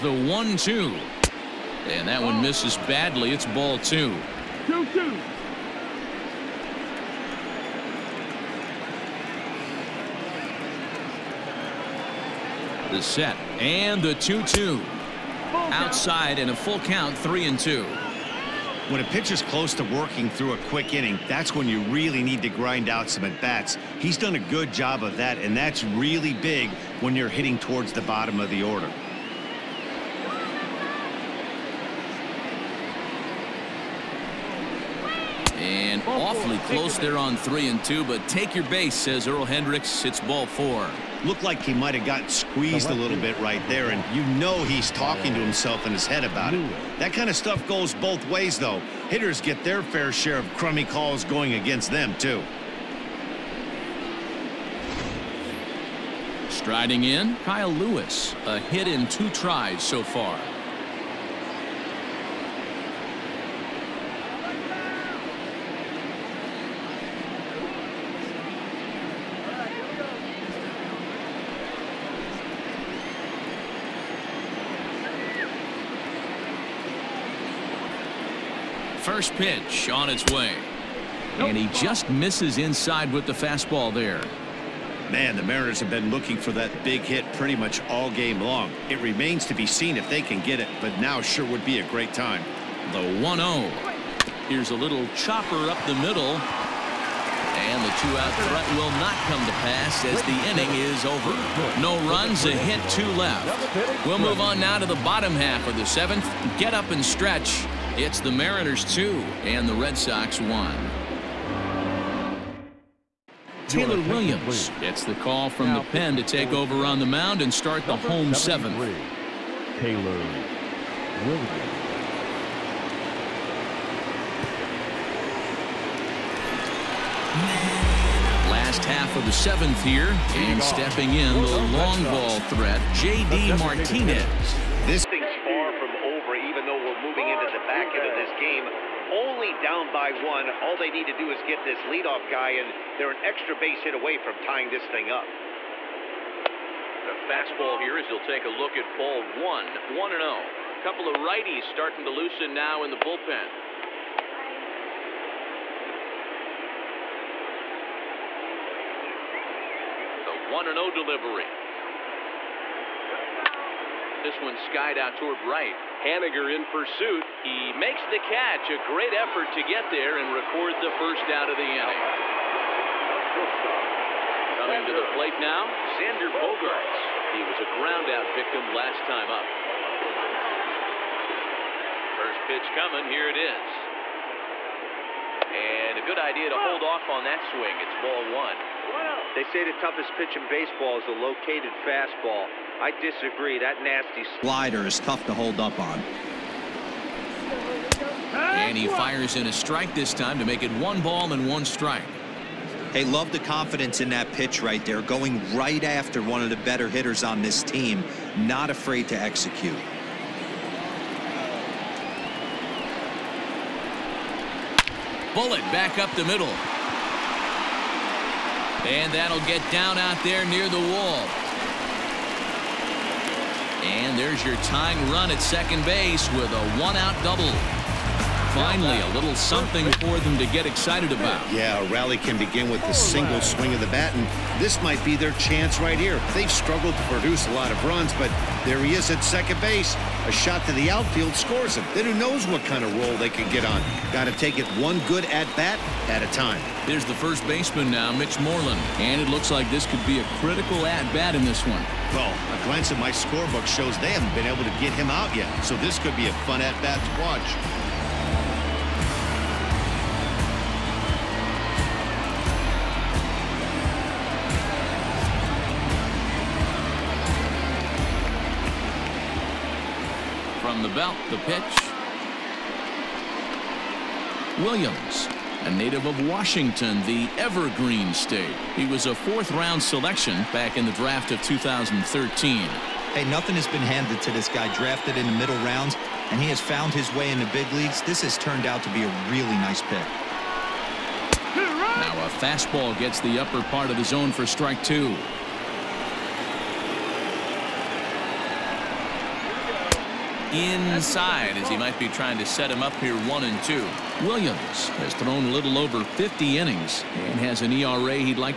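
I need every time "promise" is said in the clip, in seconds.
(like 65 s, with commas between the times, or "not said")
not said.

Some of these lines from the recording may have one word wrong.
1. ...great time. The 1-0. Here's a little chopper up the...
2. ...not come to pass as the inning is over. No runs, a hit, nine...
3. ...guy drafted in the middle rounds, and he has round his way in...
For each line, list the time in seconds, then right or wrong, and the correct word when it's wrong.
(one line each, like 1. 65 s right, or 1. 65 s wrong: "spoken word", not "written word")
1. 91 s right
2. 99 s wrong: "two", not "nine"
3. 284 s wrong: "found", not "round".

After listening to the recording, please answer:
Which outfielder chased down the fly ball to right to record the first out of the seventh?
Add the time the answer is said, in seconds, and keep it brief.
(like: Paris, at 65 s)
Haniger, at 166 s.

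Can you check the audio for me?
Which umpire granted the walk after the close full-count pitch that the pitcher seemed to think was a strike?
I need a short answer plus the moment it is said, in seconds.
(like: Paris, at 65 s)
Earl Hendricks, at 39 s.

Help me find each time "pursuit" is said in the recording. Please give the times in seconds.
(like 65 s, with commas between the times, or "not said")
166 s.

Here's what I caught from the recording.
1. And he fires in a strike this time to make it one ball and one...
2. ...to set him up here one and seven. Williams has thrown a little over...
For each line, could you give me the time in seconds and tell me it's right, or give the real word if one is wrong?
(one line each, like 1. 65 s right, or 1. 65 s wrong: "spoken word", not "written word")
1. 198 s right
2. 302 s wrong: "two", not "seven".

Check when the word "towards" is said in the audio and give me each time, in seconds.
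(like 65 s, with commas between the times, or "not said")
27 s, 165 s.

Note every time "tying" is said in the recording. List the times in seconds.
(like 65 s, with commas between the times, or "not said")
144 s, 224 s.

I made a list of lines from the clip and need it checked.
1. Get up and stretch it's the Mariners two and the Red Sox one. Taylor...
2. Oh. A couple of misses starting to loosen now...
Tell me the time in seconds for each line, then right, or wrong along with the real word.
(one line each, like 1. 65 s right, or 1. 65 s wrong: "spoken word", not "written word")
1. 106 s right
2. 150 s wrong: "righties", not "misses".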